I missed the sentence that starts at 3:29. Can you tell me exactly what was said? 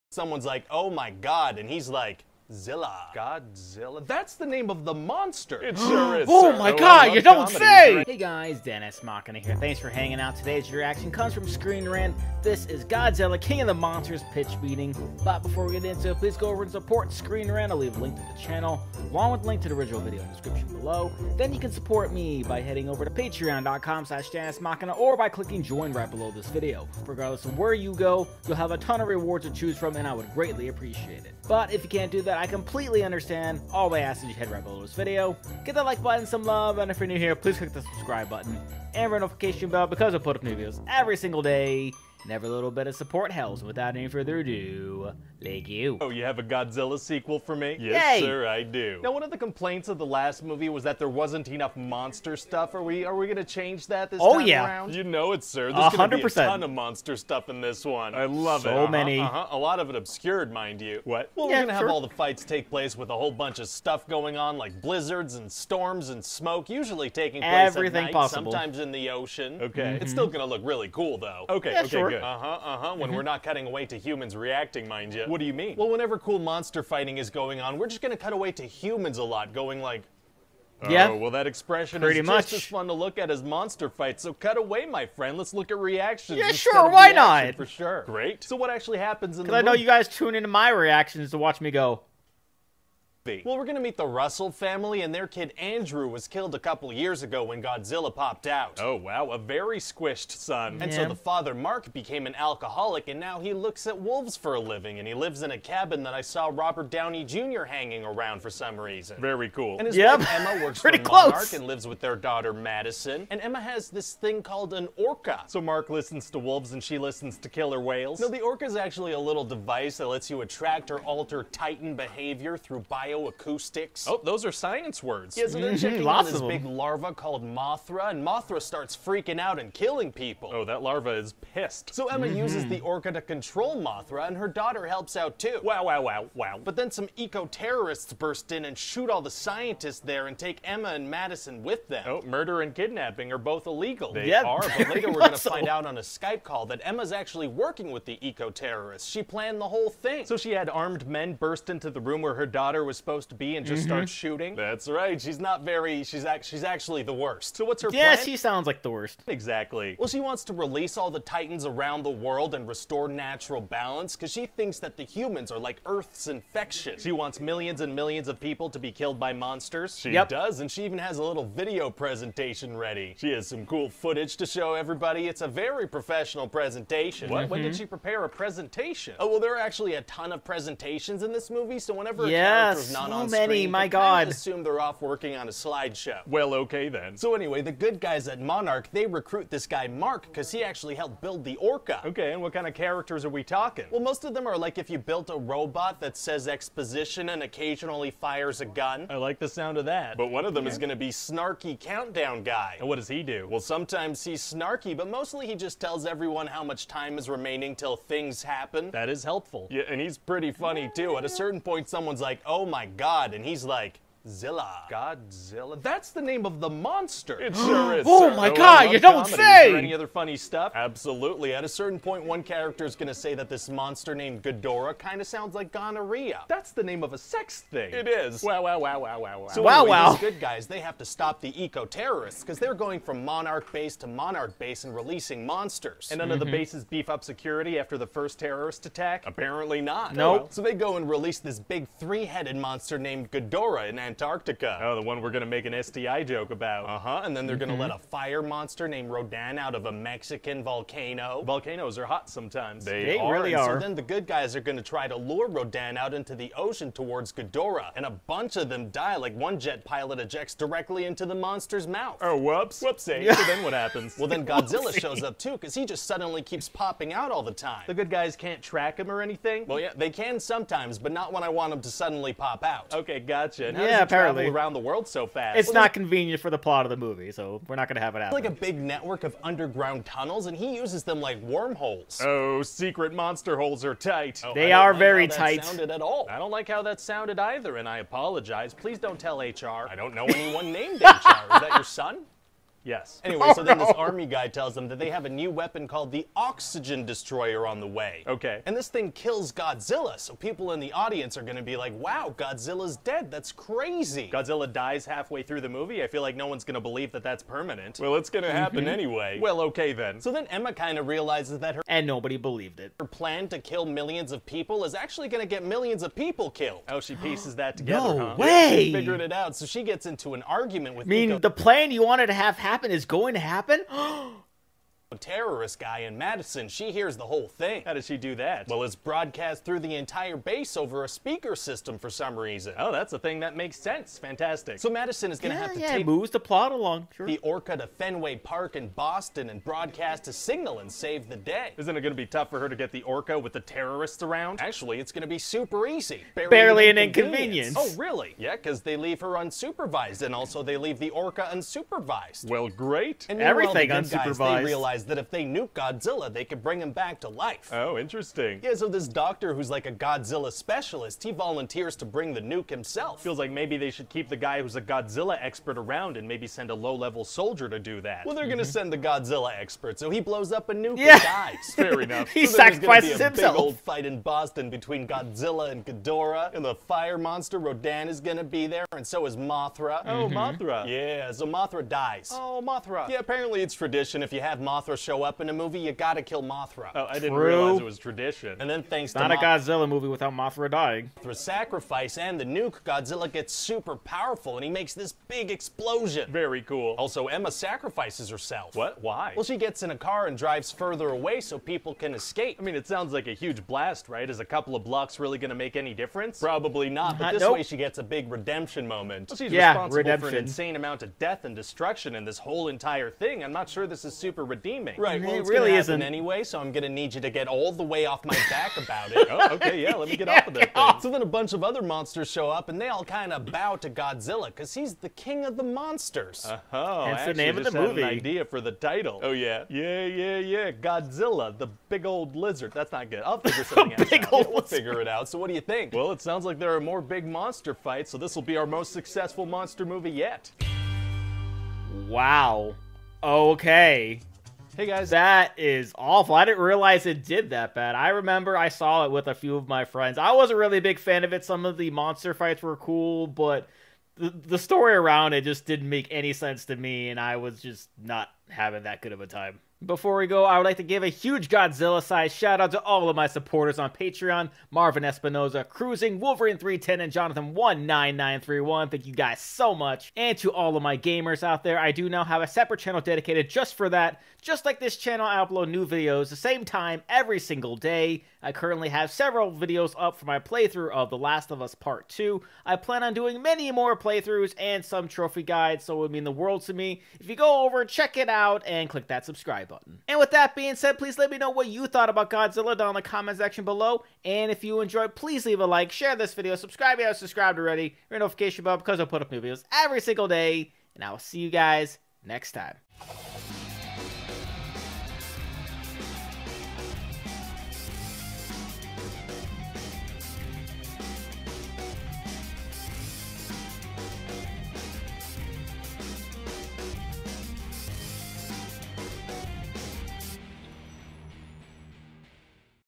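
Yeah, and he's pretty funny too.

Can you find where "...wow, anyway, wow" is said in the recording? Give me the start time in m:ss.
3:49.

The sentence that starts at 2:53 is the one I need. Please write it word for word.
She has some cool footage to show everybody.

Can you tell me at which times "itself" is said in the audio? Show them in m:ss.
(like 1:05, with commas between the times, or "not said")
not said.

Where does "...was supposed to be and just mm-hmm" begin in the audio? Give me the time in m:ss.
2:32.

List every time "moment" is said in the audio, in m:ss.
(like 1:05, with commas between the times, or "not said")
6:48.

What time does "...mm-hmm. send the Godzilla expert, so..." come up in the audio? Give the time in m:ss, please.
6:08.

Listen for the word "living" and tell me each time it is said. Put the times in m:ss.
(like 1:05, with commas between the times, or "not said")
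1:44.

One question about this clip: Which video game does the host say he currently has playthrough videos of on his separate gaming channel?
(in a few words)
The Last of Us Part 2.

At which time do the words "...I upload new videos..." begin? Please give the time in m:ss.
7:55.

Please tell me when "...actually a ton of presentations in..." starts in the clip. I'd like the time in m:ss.
2:59.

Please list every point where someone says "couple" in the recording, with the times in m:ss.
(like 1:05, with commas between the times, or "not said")
1:36, 6:44.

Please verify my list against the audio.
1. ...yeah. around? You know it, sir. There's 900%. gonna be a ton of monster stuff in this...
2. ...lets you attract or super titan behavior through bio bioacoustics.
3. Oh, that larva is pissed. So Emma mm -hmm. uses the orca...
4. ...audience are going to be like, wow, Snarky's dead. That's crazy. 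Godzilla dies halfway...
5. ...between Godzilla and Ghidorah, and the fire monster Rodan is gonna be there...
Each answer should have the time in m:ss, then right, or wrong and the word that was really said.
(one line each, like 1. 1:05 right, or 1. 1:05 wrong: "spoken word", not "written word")
1. 0:54 wrong: "100", not "900"
2. 2:00 wrong: "alter", not "super"
3. 2:10 right
4. 5:00 wrong: "Godzilla", not "Snarky"
5. 6:14 right.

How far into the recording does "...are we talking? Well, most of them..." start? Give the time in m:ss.
3:13.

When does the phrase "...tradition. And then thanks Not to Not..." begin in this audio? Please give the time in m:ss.
6:27.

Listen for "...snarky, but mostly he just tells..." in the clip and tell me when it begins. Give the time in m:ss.
3:24.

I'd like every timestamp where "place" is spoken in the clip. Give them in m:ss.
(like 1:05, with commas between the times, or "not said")
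1:02, 1:07.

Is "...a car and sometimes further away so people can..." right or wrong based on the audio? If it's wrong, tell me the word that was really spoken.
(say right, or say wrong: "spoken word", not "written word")
wrong: "drives", not "sometimes".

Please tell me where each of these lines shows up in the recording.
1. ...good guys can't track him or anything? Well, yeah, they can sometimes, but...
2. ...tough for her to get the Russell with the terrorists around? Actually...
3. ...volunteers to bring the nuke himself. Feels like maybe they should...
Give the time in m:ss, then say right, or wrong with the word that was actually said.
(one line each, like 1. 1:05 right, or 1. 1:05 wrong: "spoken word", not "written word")
1. 4:27 right
2. 5:42 wrong: "Orca", not "Russell"
3. 6:01 right.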